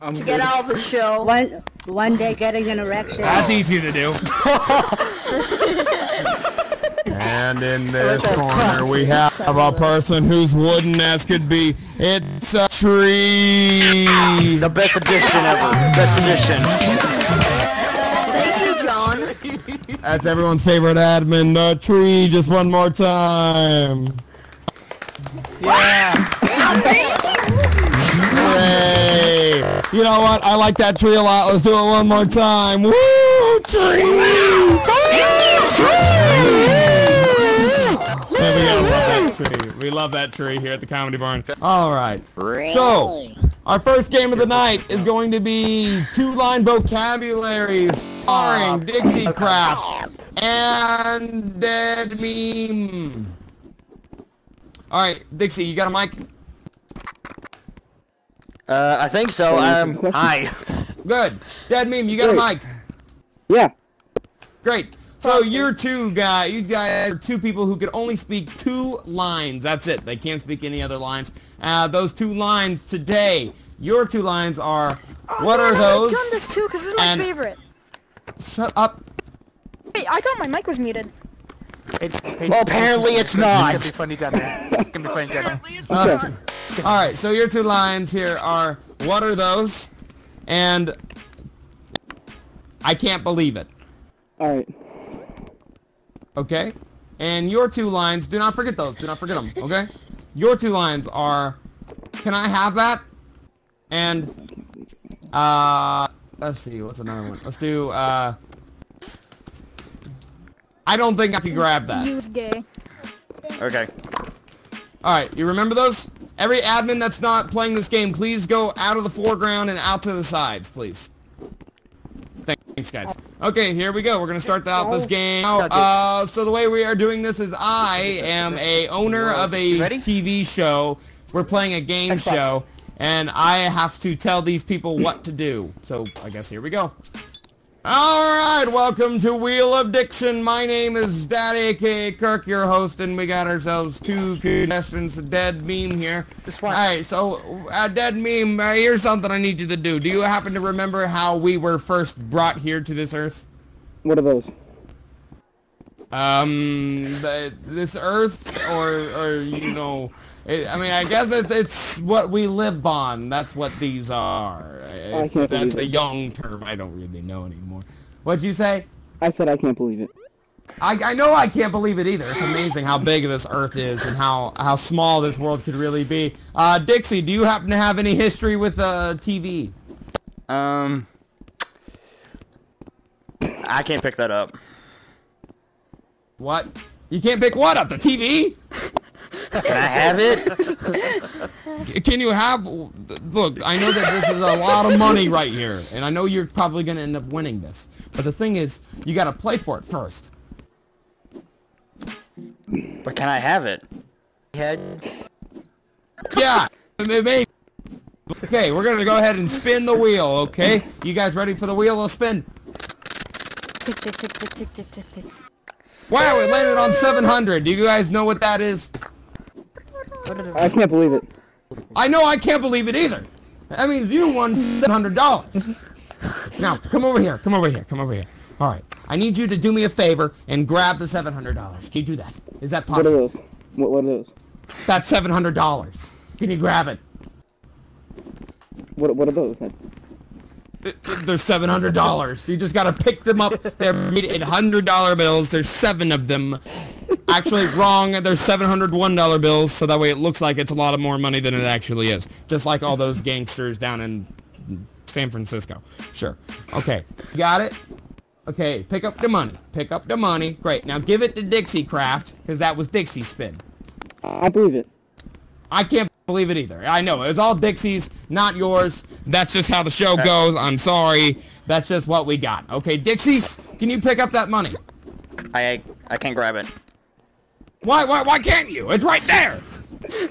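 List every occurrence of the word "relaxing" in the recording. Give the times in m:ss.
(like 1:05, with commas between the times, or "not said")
not said.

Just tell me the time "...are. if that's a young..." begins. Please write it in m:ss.
2:44.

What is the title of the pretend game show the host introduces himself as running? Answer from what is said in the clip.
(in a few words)
Wheel of Diction.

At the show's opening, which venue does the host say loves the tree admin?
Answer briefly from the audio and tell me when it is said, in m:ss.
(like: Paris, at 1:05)
Comedy Barn, at 0:40.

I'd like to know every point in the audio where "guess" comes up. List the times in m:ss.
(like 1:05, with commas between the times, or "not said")
2:16, 2:41.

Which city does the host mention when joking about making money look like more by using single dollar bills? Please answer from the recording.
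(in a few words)
San Francisco.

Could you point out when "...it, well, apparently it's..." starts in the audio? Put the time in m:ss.
1:22.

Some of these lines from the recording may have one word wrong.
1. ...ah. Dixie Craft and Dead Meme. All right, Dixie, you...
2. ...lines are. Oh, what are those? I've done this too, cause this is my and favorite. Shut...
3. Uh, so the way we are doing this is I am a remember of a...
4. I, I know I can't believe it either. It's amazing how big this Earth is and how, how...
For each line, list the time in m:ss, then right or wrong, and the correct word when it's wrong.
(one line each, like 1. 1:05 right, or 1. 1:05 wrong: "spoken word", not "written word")
1. 0:48 right
2. 1:14 right
3. 2:05 wrong: "owner", not "remember"
4. 2:50 right.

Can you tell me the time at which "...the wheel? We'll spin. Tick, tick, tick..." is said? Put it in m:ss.
3:31.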